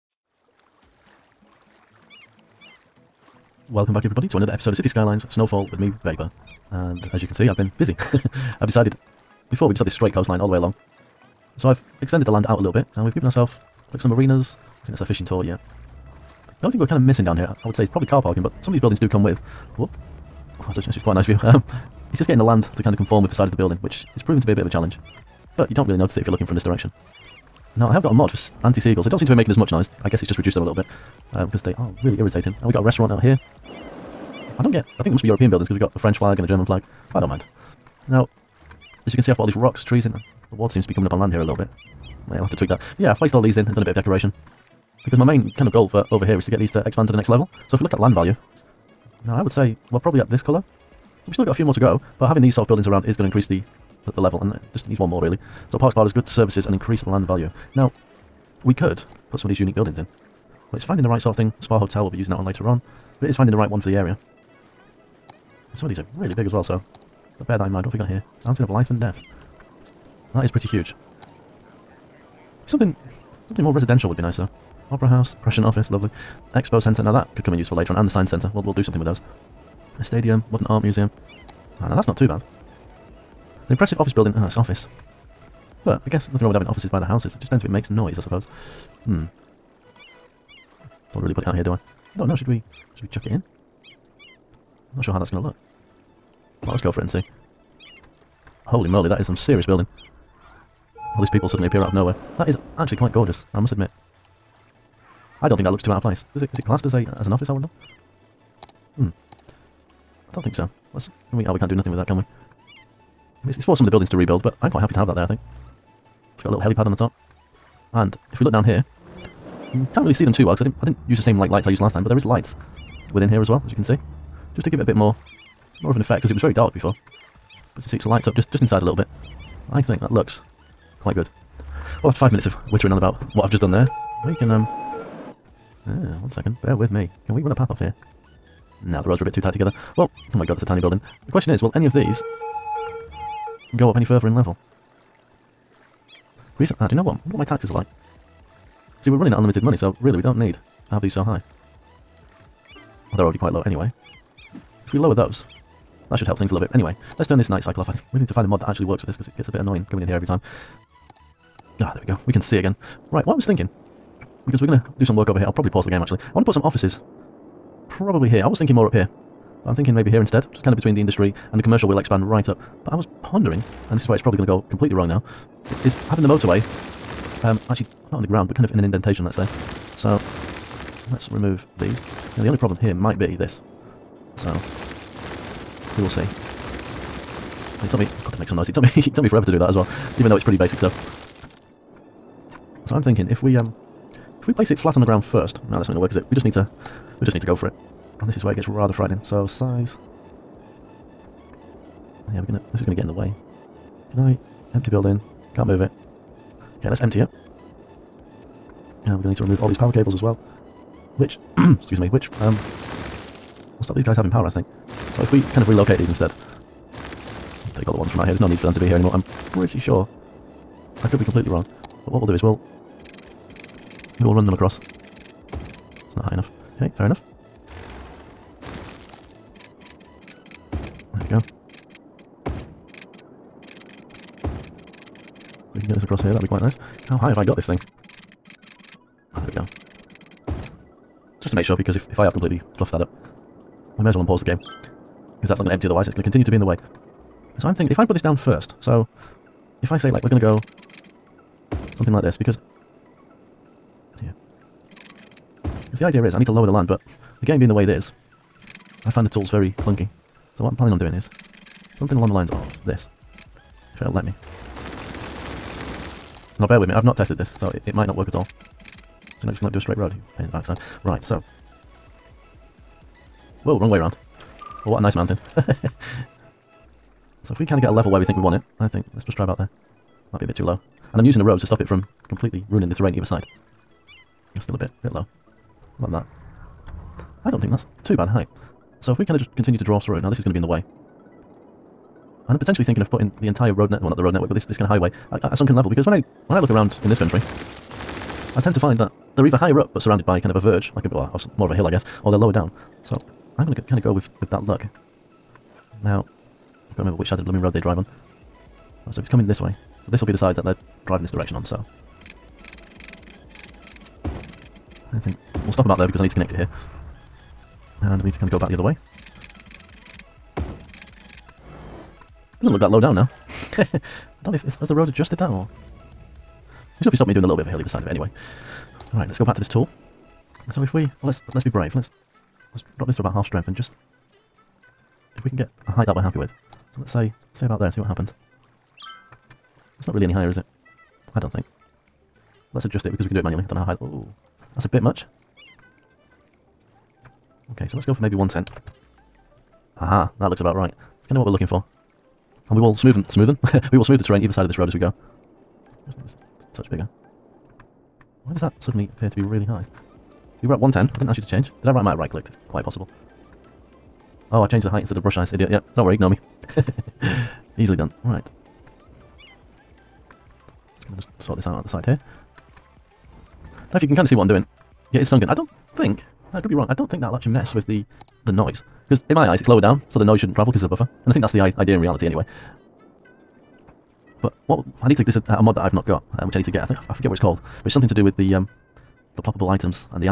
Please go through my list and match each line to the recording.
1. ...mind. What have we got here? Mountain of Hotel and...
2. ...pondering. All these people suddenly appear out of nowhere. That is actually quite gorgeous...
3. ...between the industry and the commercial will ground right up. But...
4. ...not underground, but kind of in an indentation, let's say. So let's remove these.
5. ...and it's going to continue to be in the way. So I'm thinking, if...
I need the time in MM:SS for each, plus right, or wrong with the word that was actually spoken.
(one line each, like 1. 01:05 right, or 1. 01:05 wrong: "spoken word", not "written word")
1. 01:07 wrong: "Life", not "Hotel"
2. 01:39 wrong: "building", not "pondering"
3. 02:50 wrong: "expand", not "ground"
4. 02:58 right
5. 04:06 right.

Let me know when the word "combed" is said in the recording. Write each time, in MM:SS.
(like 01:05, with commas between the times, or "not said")
not said.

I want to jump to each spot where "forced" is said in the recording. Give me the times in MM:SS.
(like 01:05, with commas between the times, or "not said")
01:53.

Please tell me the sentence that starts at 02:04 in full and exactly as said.
Just to give it a bit more, more of an effect, because it was very dark before.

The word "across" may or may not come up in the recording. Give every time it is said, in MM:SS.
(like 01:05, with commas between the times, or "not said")
03:44, 03:56.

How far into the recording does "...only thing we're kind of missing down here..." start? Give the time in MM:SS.
00:16.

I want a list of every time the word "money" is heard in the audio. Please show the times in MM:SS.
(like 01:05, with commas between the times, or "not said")
02:29.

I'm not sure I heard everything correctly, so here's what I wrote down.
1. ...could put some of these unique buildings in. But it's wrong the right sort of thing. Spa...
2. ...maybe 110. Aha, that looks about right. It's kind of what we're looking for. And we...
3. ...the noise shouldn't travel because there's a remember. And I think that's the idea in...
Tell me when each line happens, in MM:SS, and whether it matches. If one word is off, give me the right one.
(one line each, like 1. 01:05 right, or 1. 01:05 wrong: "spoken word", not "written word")
1. 00:58 wrong: "finding", not "wrong"
2. 05:48 right
3. 06:20 wrong: "buffer", not "remember".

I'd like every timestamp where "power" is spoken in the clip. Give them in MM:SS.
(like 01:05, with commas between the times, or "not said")
03:29, 03:34.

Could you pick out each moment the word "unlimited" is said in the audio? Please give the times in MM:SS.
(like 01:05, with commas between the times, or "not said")
02:29.